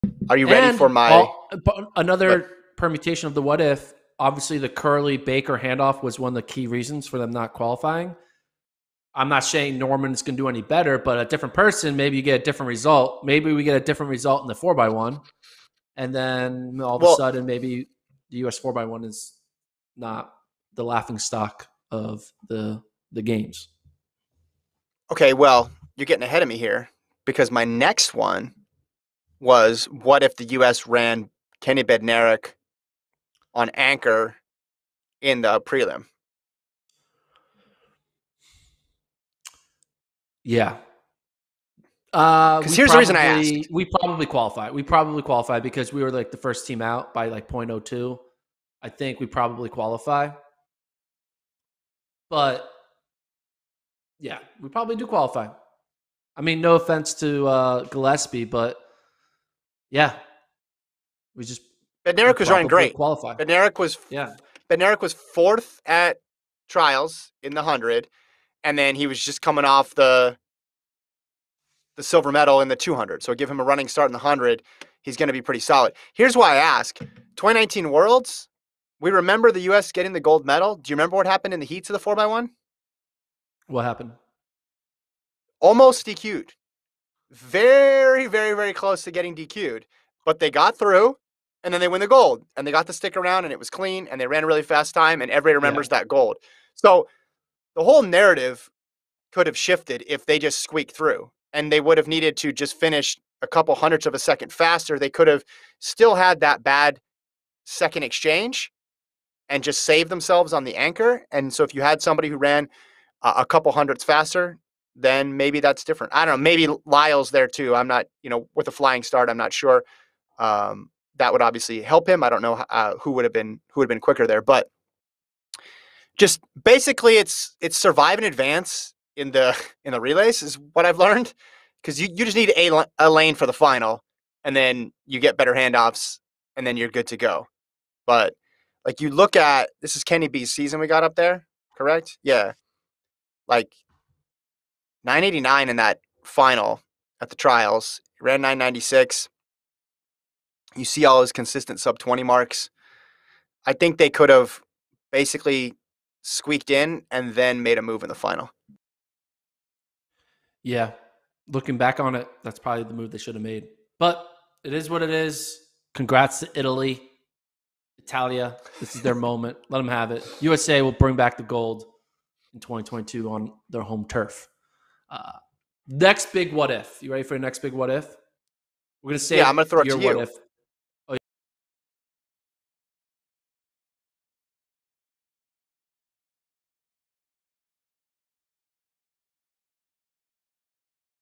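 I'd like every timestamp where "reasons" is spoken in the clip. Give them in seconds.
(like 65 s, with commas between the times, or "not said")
6 s, 42 s.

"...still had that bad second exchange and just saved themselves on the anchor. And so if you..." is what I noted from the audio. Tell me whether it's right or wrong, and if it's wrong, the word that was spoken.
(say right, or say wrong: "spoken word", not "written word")
right.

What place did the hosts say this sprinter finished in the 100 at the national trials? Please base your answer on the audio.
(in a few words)
fourth.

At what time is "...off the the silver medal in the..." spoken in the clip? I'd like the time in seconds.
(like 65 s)
69 s.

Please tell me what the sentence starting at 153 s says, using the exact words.
I think they could have basically squeaked in and then made a move in the final.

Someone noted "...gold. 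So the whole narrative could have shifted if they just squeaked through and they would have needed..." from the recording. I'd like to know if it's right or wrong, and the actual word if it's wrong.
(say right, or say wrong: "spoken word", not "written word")
right.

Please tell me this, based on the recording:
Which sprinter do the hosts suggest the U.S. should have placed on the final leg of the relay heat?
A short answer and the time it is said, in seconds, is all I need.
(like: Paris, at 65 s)
Kenny Bednarek, at 31 s.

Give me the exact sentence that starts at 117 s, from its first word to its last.
I'm not, you know, with a flying start, I'm not sure.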